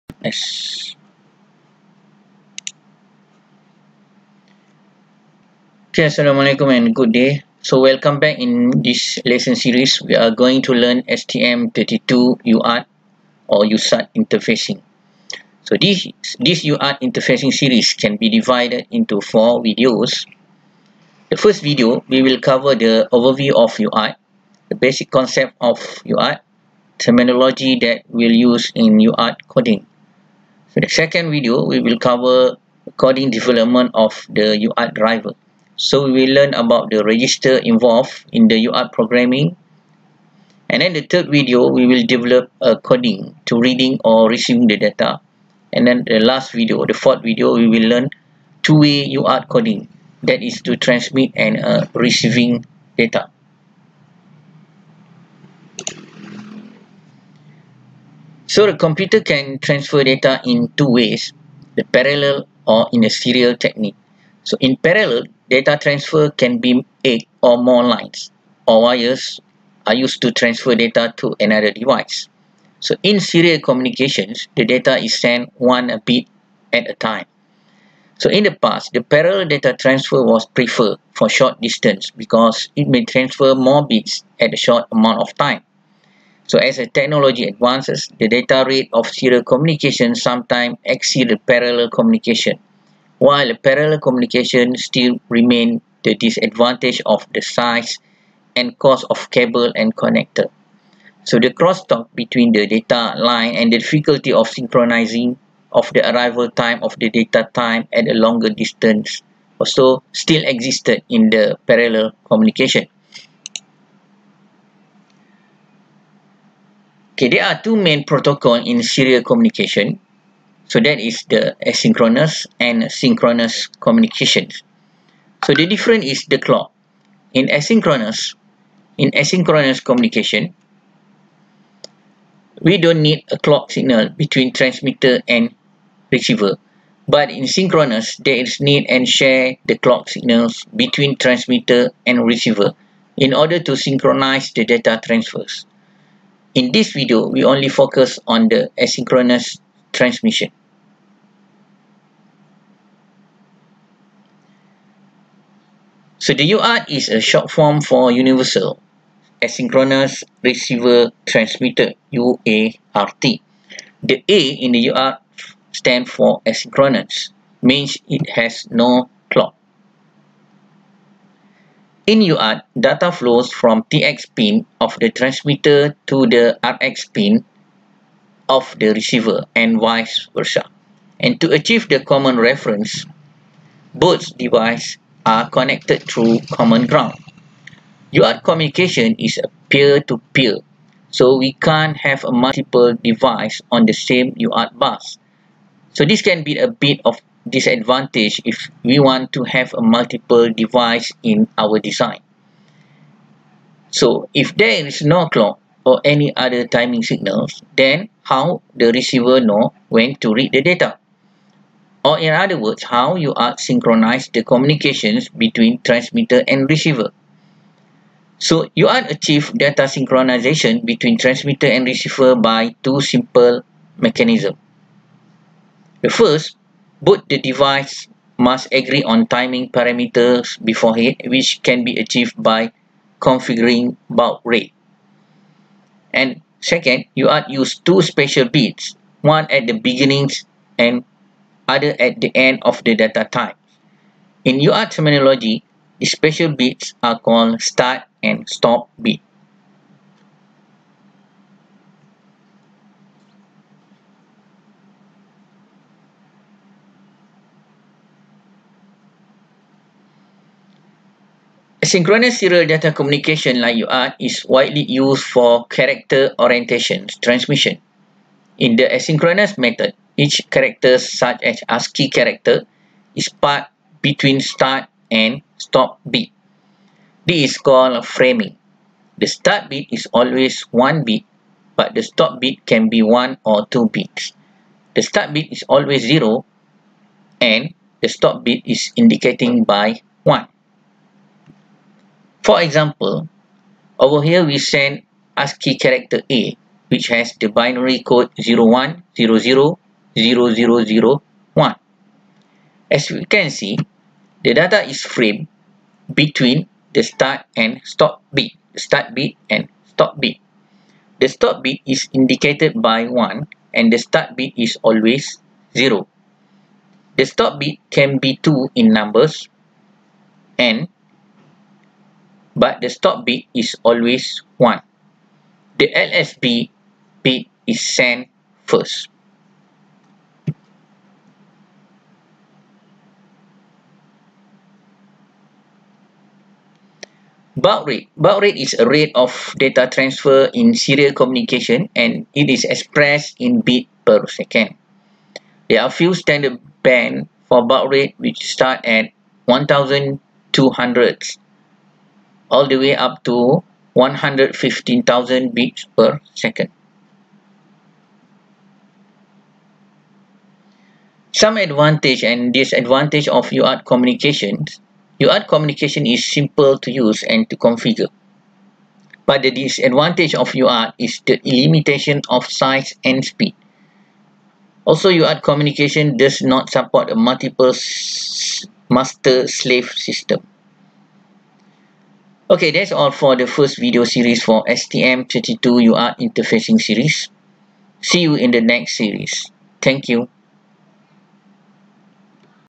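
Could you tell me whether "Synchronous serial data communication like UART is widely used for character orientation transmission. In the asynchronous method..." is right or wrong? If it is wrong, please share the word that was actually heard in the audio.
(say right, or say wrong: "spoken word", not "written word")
right.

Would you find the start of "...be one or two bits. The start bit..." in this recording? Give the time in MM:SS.
04:42.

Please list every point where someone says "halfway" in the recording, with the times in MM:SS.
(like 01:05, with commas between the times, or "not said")
not said.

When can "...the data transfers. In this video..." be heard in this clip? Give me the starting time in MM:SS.
02:24.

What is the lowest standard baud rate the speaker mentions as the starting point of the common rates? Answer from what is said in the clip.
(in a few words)
1200.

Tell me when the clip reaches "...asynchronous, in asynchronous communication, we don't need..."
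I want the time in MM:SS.
02:07.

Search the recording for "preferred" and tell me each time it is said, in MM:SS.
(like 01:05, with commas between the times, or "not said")
01:20.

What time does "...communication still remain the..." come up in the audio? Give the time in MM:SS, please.
01:34.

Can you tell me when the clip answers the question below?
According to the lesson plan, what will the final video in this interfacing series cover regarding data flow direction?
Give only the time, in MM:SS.
00:48.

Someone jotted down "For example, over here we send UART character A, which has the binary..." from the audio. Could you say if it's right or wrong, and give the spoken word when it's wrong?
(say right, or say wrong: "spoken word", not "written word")
wrong: "ASCII", not "UART".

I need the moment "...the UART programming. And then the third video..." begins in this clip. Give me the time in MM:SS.
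00:38.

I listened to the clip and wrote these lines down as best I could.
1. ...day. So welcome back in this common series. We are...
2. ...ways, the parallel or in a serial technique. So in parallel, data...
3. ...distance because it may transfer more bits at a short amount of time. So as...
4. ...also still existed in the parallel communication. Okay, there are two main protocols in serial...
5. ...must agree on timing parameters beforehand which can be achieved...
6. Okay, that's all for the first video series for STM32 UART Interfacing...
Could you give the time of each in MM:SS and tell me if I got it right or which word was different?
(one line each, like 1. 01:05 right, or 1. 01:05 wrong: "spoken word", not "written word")
1. 00:07 wrong: "lesson", not "common"
2. 01:00 right
3. 01:21 right
4. 01:49 right
5. 03:48 right
6. 06:22 right.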